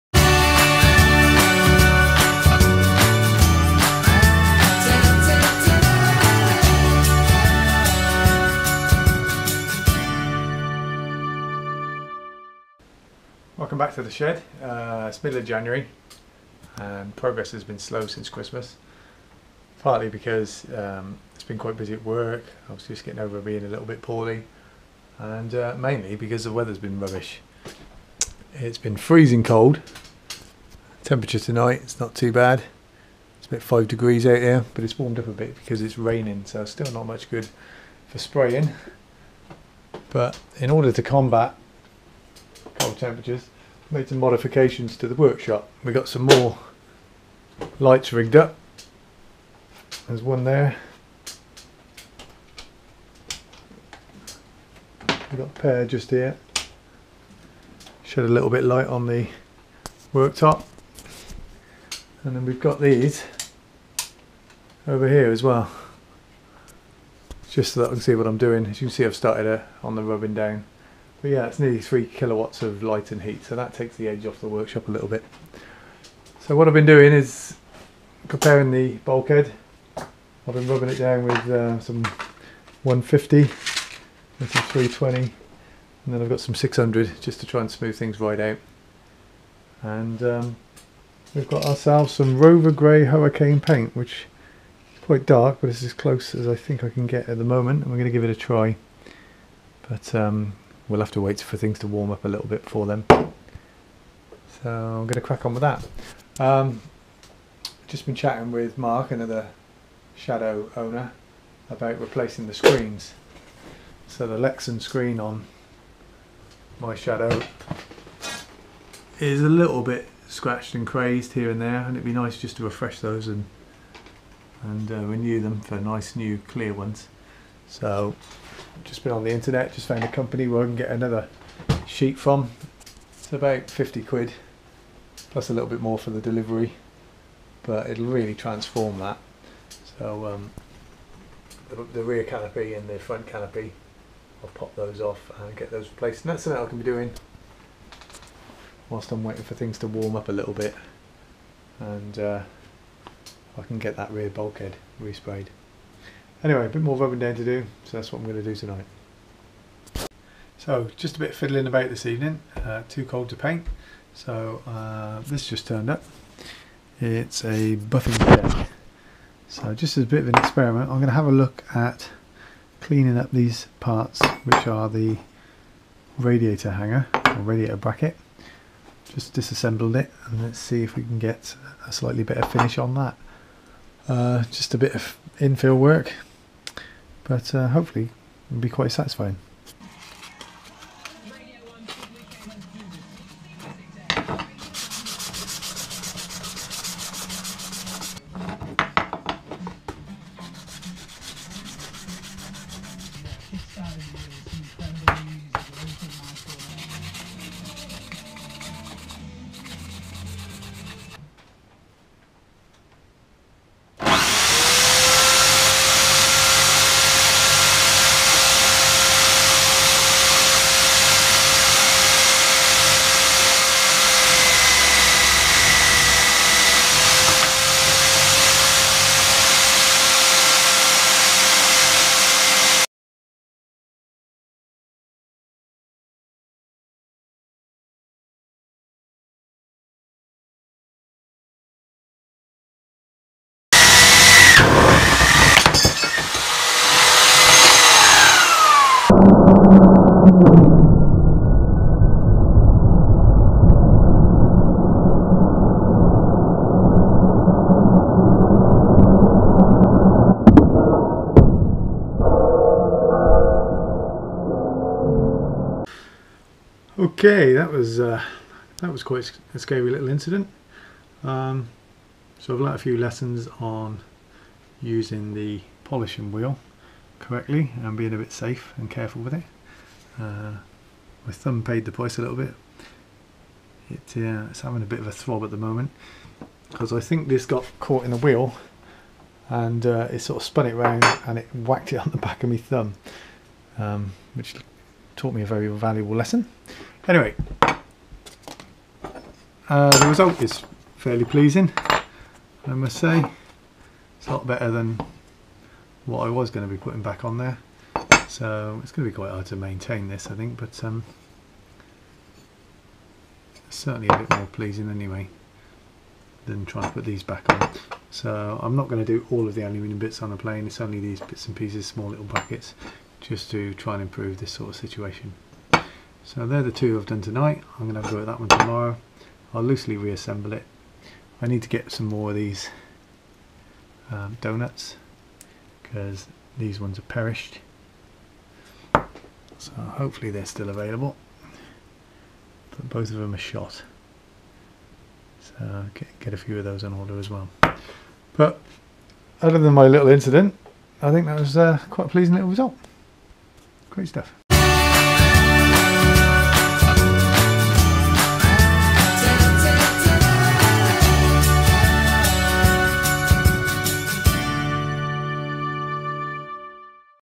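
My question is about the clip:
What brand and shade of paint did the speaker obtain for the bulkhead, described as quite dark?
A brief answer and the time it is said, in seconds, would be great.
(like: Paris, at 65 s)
Rover Grey Hurricane, at 92 s.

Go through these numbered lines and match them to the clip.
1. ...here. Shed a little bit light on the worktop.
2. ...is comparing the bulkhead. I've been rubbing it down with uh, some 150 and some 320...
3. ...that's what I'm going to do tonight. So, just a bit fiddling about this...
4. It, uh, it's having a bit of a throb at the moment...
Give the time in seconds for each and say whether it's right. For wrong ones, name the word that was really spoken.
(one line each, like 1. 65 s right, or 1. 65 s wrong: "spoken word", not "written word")
1. 56 s right
2. 77 s right
3. 157 s right
4. 283 s right.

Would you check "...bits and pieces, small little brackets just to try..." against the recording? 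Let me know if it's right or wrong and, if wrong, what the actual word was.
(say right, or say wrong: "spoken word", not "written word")
right.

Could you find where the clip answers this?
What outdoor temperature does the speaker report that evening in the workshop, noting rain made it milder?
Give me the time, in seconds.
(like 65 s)
33 s.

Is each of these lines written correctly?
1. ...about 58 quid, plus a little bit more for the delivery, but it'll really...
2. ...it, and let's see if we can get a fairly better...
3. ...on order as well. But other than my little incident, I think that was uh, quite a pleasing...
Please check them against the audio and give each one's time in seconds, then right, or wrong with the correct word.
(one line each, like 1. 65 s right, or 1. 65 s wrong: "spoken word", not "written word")
1. 133 s wrong: "50", not "58"
2. 179 s wrong: "slightly", not "fairly"
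3. 346 s right.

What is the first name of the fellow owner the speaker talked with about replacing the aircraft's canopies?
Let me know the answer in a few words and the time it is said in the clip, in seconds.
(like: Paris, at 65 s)
Mark, at 108 s.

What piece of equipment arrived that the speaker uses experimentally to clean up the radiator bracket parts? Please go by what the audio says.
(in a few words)
buffing deck.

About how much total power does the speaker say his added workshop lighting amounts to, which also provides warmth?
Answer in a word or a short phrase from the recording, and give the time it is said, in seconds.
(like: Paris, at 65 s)
nearly 3 kilowatts, at 71 s.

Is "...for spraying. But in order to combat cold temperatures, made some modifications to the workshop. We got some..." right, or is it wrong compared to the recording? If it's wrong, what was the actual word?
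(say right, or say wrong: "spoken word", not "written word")
right.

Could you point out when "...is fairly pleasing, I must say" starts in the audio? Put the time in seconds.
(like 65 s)
300 s.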